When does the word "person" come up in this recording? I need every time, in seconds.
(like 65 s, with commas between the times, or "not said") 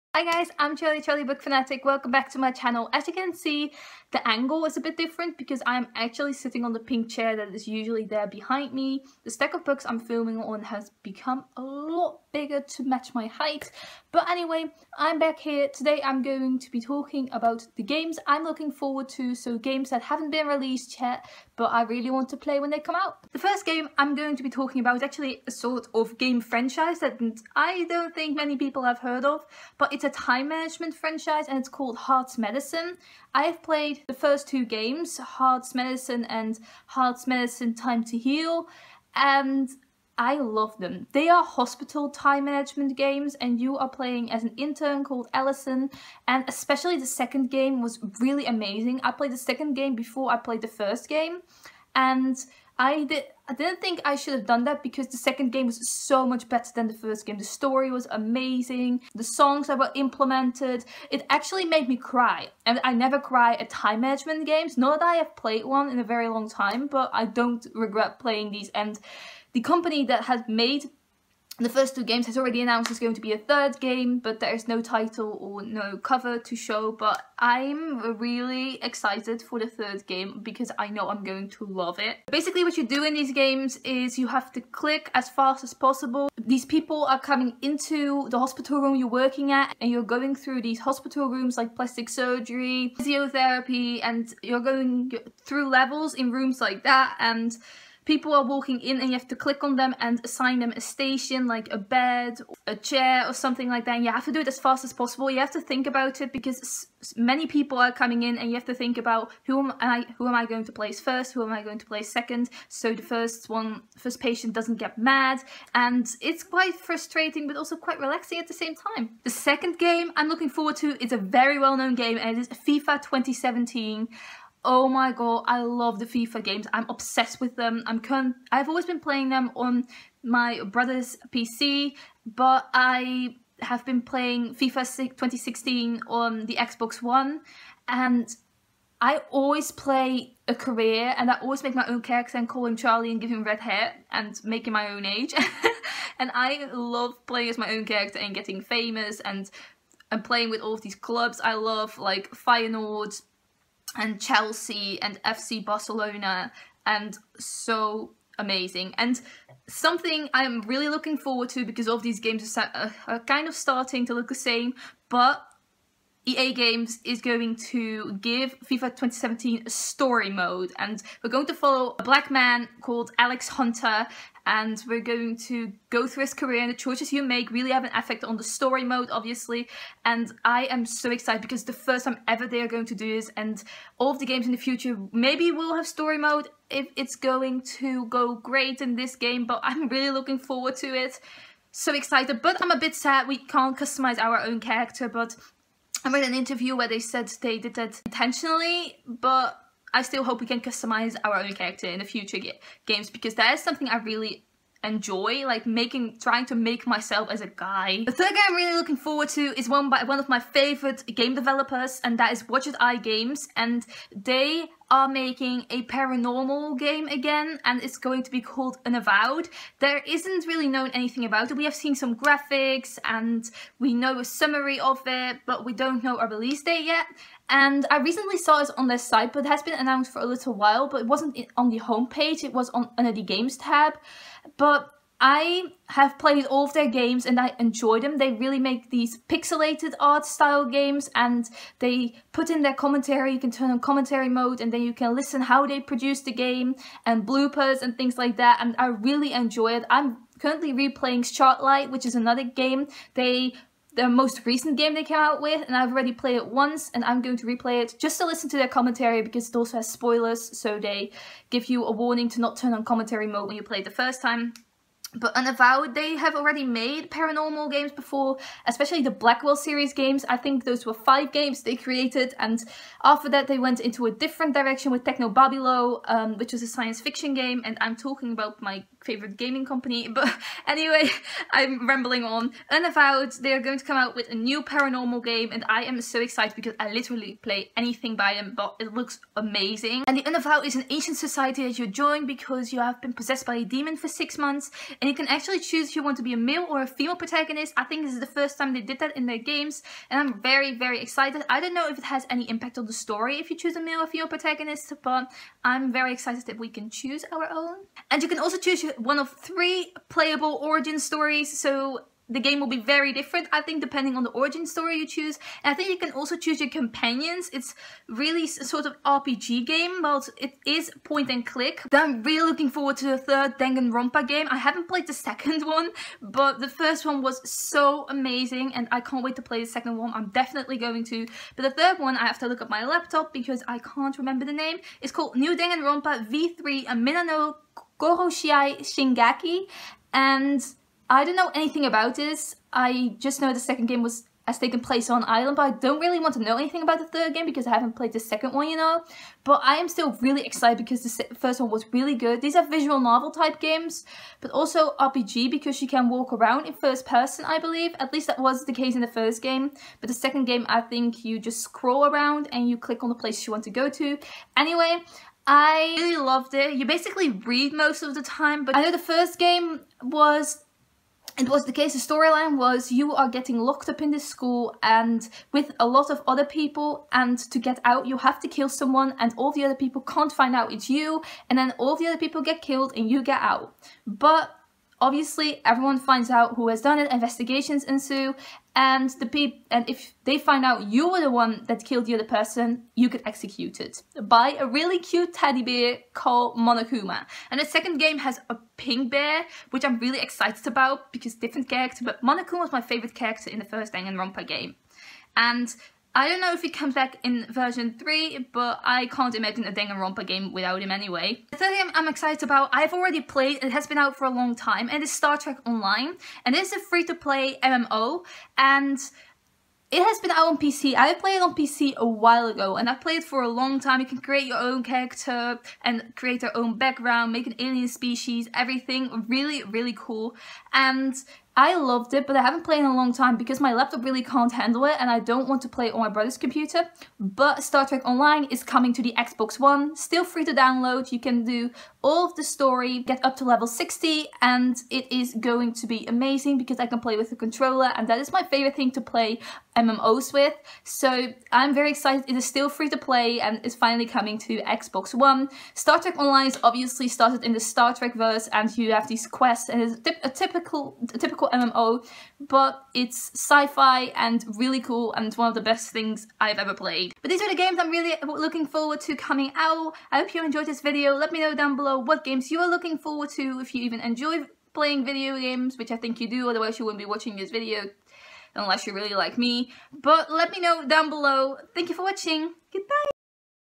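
357 s, 392 s.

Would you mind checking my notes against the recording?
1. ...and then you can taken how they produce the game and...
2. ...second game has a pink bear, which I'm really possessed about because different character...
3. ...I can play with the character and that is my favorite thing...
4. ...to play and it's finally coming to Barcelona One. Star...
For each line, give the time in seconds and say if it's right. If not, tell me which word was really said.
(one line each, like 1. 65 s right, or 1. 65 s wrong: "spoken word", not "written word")
1. 244 s wrong: "listen", not "taken"
2. 397 s wrong: "excited", not "possessed"
3. 446 s wrong: "controller", not "character"
4. 452 s wrong: "Xbox", not "Barcelona".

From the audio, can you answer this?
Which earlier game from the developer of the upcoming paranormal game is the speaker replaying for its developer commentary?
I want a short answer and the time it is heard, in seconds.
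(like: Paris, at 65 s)
Shardlight, at 251 s.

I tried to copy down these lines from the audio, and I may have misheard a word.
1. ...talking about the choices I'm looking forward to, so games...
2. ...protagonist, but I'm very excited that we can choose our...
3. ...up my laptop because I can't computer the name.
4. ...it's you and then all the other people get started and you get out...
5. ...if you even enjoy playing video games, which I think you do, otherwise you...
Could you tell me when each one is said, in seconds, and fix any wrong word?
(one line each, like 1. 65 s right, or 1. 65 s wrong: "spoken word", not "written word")
1. 16 s wrong: "games", not "choices"
2. 304 s right
3. 332 s wrong: "remember", not "computer"
4. 380 s wrong: "killed", not "started"
5. 473 s right.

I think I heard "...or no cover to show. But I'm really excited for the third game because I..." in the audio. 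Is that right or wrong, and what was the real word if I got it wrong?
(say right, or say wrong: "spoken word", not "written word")
right.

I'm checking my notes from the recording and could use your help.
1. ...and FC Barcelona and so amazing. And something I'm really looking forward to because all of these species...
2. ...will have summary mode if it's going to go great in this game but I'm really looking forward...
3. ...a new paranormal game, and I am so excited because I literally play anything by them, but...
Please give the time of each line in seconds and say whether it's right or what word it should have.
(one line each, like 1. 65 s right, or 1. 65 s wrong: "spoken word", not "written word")
1. 155 s wrong: "games", not "species"
2. 185 s wrong: "story", not "summary"
3. 284 s right.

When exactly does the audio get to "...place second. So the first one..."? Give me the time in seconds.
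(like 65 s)
111 s.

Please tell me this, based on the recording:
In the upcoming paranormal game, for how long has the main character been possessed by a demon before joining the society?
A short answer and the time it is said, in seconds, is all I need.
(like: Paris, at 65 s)
6 months, at 294 s.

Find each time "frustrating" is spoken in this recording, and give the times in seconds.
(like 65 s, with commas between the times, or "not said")
116 s.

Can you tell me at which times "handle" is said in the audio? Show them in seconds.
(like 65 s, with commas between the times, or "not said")
434 s.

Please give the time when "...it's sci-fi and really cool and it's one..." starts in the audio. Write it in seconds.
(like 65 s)
462 s.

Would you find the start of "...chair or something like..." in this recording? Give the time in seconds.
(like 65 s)
102 s.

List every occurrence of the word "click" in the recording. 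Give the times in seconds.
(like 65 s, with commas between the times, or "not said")
84 s, 99 s, 321 s, 362 s.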